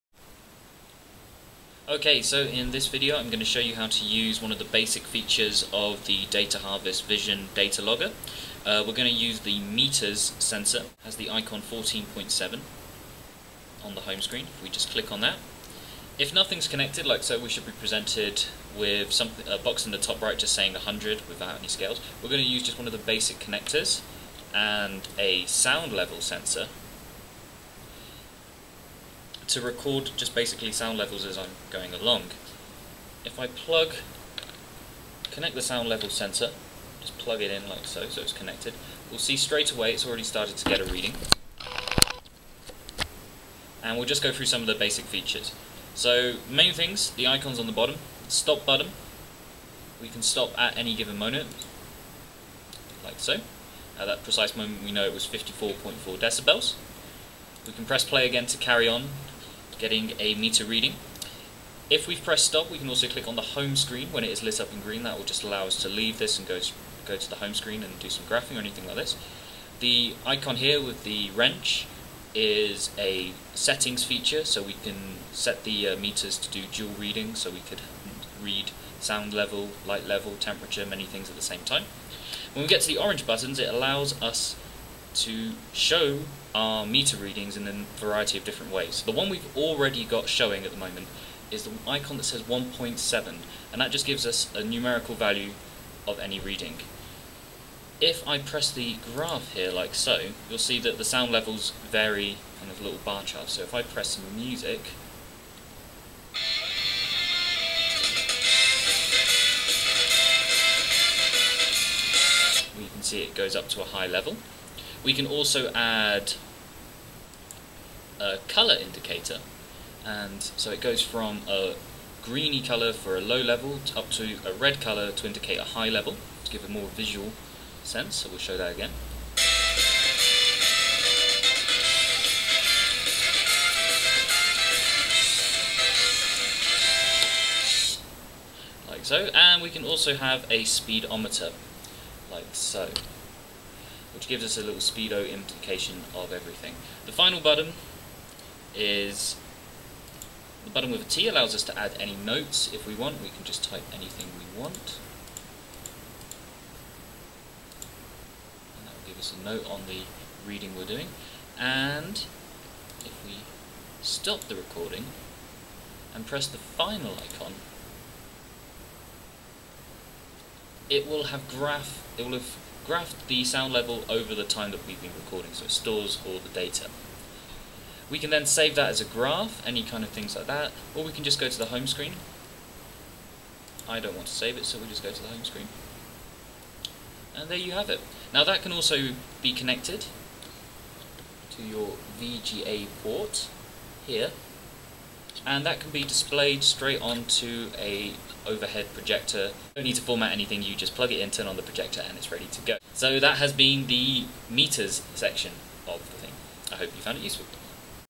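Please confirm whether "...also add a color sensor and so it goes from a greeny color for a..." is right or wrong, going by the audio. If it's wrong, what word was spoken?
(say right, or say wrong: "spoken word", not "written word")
wrong: "indicator", not "sensor".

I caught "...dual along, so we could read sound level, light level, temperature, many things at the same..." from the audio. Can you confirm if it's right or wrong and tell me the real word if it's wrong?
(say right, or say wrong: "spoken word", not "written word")
wrong: "reading", not "along".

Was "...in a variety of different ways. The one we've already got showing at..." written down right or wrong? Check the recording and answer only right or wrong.
right.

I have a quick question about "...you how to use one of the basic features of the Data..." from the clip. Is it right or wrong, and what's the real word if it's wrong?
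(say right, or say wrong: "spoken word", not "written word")
right.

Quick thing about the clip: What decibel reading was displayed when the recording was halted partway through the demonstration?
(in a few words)
54.4.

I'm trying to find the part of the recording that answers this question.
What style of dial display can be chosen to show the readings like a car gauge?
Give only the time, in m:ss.
2:20.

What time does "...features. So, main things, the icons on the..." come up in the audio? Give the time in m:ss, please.
0:45.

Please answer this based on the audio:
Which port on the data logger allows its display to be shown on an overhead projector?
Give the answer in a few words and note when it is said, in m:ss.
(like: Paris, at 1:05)
VGA port, at 3:12.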